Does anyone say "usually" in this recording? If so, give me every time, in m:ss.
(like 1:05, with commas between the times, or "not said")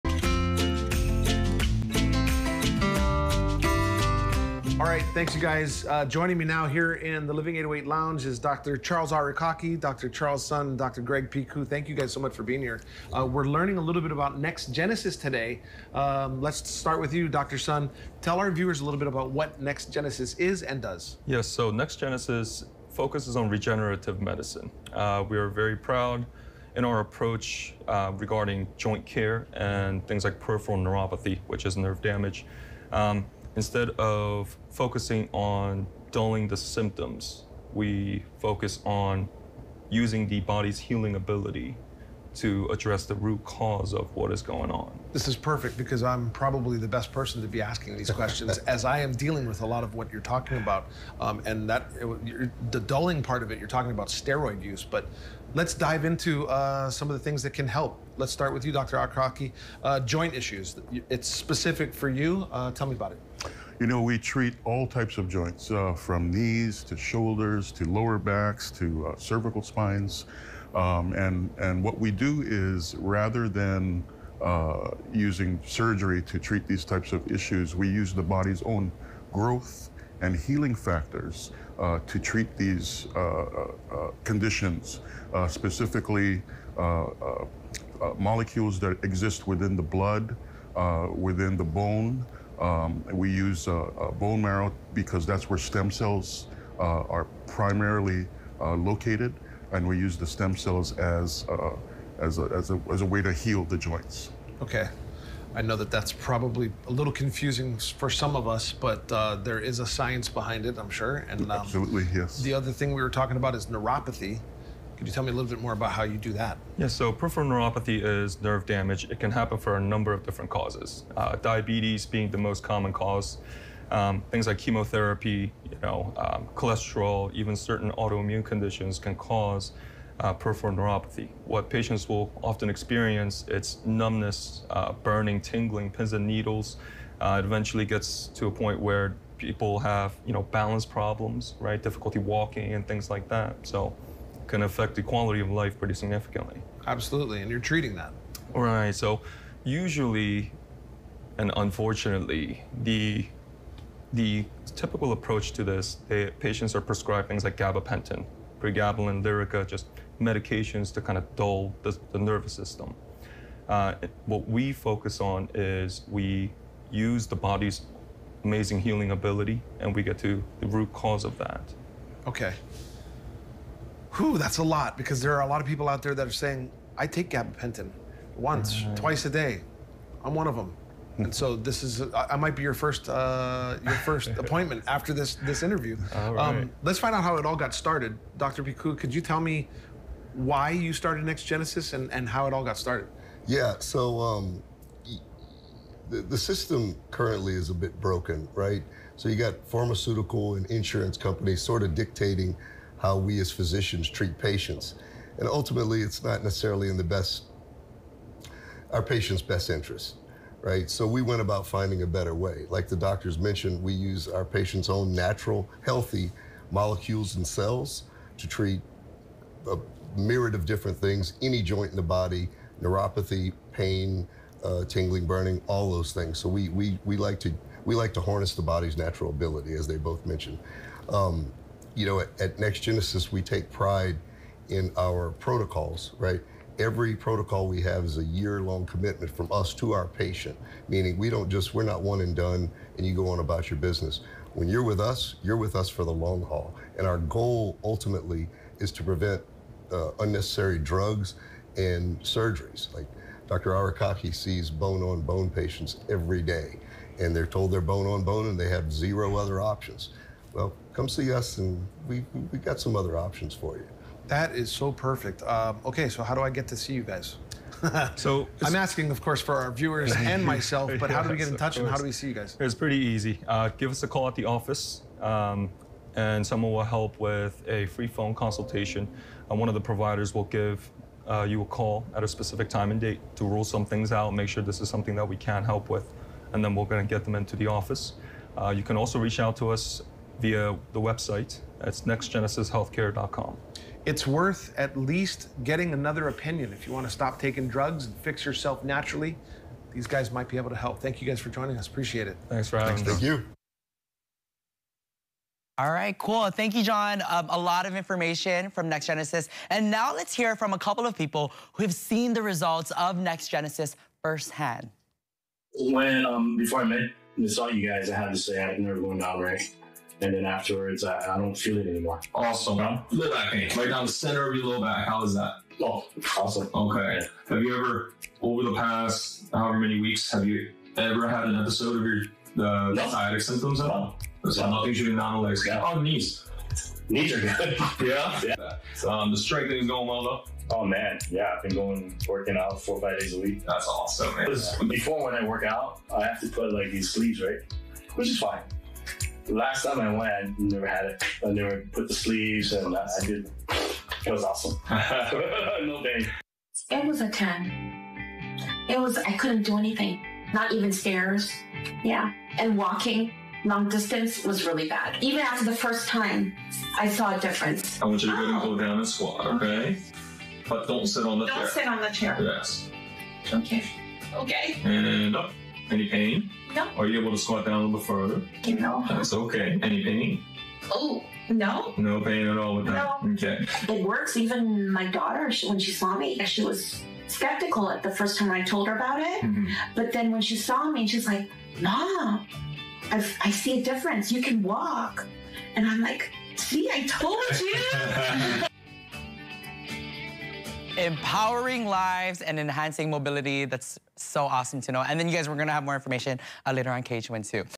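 2:29.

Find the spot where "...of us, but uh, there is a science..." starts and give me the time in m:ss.
1:48.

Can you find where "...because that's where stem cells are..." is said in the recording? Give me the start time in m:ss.
1:34.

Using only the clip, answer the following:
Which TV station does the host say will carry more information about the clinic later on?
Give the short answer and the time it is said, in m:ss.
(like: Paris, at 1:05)
KHON2, at 6:47.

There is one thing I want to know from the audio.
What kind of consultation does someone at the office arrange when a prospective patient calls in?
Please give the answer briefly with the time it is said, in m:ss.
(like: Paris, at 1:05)
Free phone consultation, at 4:37.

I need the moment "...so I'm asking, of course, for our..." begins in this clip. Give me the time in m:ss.
4:28.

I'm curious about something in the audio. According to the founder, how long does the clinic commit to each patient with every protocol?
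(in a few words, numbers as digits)
Year-long.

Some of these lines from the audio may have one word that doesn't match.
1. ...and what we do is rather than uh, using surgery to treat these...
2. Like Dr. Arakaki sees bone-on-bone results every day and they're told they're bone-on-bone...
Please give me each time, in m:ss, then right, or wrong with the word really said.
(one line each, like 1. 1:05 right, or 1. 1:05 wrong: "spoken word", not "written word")
1. 1:11 right
2. 4:12 wrong: "patients", not "results".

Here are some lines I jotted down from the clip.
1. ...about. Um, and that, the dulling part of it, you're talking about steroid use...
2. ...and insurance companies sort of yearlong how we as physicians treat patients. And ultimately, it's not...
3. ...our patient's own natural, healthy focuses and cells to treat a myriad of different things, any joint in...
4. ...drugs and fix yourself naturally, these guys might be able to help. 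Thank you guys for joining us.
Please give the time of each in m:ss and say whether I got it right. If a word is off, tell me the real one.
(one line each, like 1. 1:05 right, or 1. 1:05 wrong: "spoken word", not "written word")
1. 0:50 right
2. 3:20 wrong: "dictating", not "yearlong"
3. 3:34 wrong: "molecules", not "focuses"
4. 4:57 right.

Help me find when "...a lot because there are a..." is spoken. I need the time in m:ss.
2:54.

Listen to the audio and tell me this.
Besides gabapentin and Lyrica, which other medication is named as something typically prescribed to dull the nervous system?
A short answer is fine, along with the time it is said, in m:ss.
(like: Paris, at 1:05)
Pregabalin, at 2:38.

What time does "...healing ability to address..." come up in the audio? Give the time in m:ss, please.
0:40.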